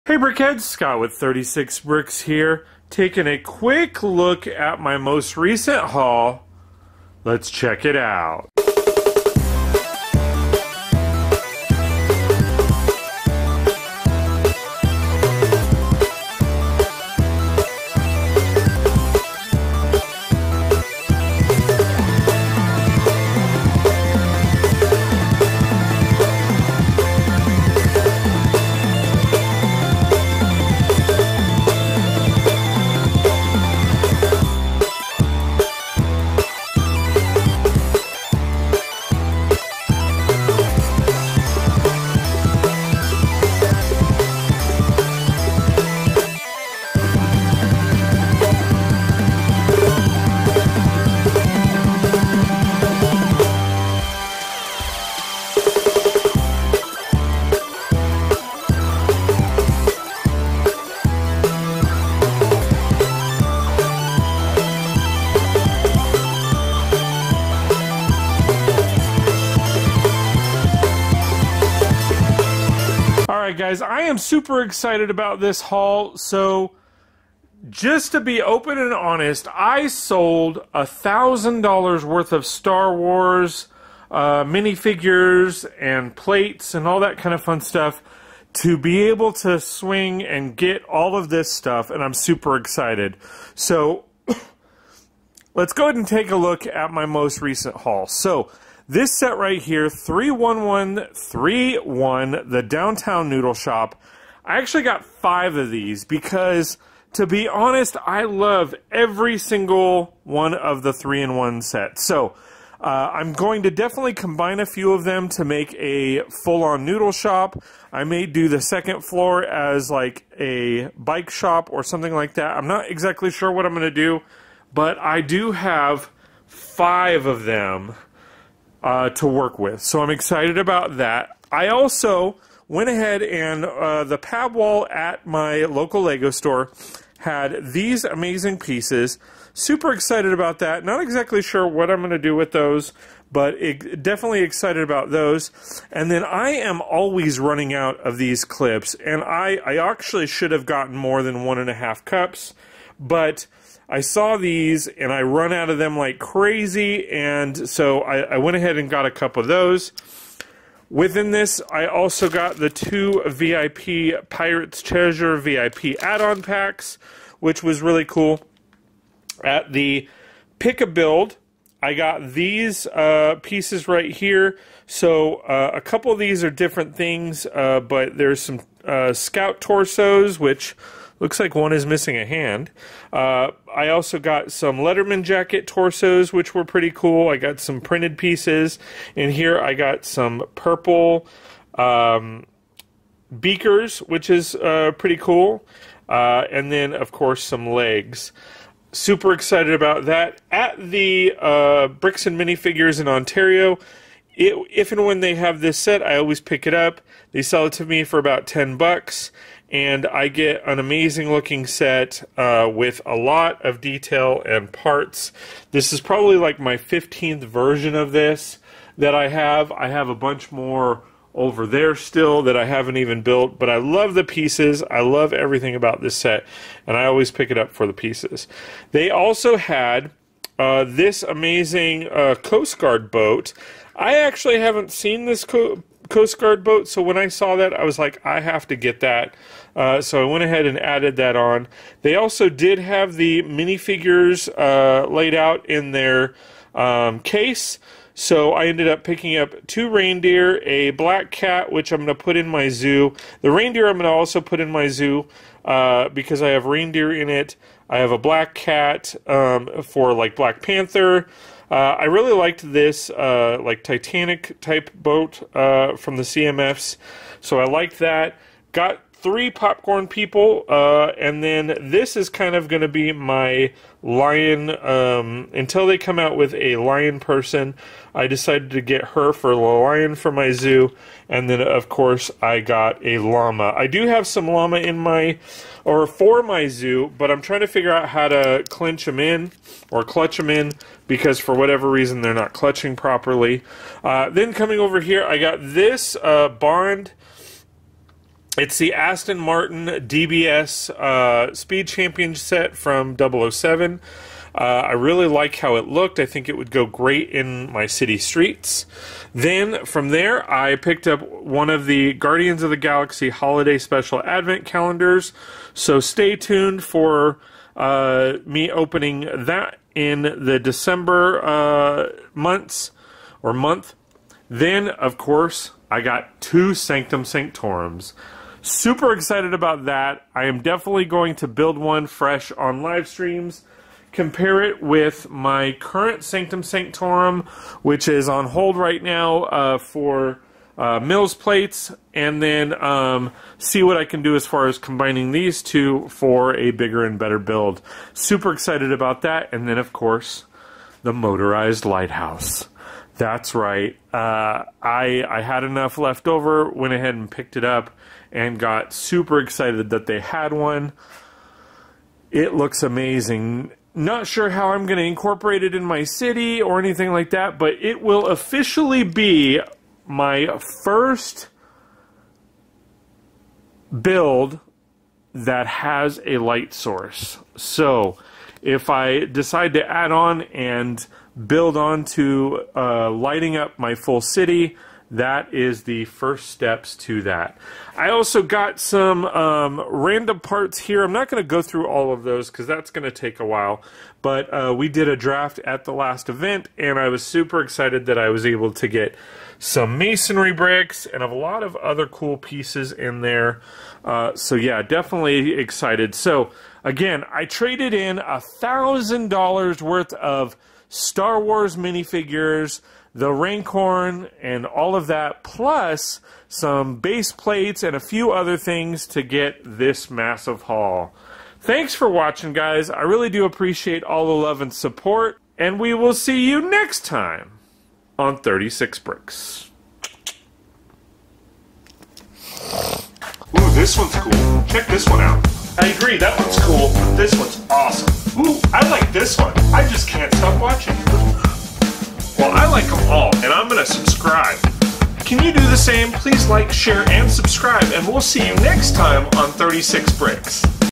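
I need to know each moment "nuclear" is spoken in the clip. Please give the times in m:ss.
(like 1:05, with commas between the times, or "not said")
not said.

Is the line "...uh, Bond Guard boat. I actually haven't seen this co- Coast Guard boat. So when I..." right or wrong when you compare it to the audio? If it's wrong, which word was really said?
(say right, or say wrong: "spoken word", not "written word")
wrong: "Coast", not "Bond".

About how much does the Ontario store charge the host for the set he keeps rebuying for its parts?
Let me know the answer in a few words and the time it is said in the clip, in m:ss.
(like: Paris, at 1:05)
$10, at 3:28.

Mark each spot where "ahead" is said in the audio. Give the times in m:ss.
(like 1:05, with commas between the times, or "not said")
1:35, 2:12, 2:38, 4:00, 5:56.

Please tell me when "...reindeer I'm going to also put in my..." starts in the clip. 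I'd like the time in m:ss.
4:13.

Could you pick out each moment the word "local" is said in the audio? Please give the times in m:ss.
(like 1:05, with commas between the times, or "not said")
2:15.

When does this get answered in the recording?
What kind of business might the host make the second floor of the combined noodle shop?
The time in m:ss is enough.
2:00.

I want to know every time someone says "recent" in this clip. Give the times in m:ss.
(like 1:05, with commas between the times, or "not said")
0:05, 1:37.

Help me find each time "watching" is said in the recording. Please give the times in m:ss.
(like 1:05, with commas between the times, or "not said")
7:02.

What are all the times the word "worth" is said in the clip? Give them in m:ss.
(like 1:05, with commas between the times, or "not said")
1:22, 6:49.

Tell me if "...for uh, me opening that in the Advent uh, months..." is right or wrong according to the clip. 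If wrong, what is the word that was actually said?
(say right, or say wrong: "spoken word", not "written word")
wrong: "December", not "Advent".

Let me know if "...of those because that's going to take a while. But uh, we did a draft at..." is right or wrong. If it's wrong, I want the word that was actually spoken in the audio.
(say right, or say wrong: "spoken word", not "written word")
right.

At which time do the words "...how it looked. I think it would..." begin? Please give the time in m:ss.
5:05.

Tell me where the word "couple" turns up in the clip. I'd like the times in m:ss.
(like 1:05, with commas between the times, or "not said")
2:39, 2:55.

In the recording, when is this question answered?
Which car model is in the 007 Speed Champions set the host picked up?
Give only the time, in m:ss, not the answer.
4:58.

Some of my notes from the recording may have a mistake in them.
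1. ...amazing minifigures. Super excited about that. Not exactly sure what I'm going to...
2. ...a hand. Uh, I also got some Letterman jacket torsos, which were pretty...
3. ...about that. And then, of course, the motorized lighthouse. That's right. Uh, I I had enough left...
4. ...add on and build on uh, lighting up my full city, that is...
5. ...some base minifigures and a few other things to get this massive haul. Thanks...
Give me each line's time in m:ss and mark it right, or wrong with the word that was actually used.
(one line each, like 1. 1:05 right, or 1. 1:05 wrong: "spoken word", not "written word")
1. 2:18 wrong: "pieces", not "minifigures"
2. 3:02 right
3. 5:48 right
4. 6:19 right
5. 6:56 wrong: "plates", not "minifigures".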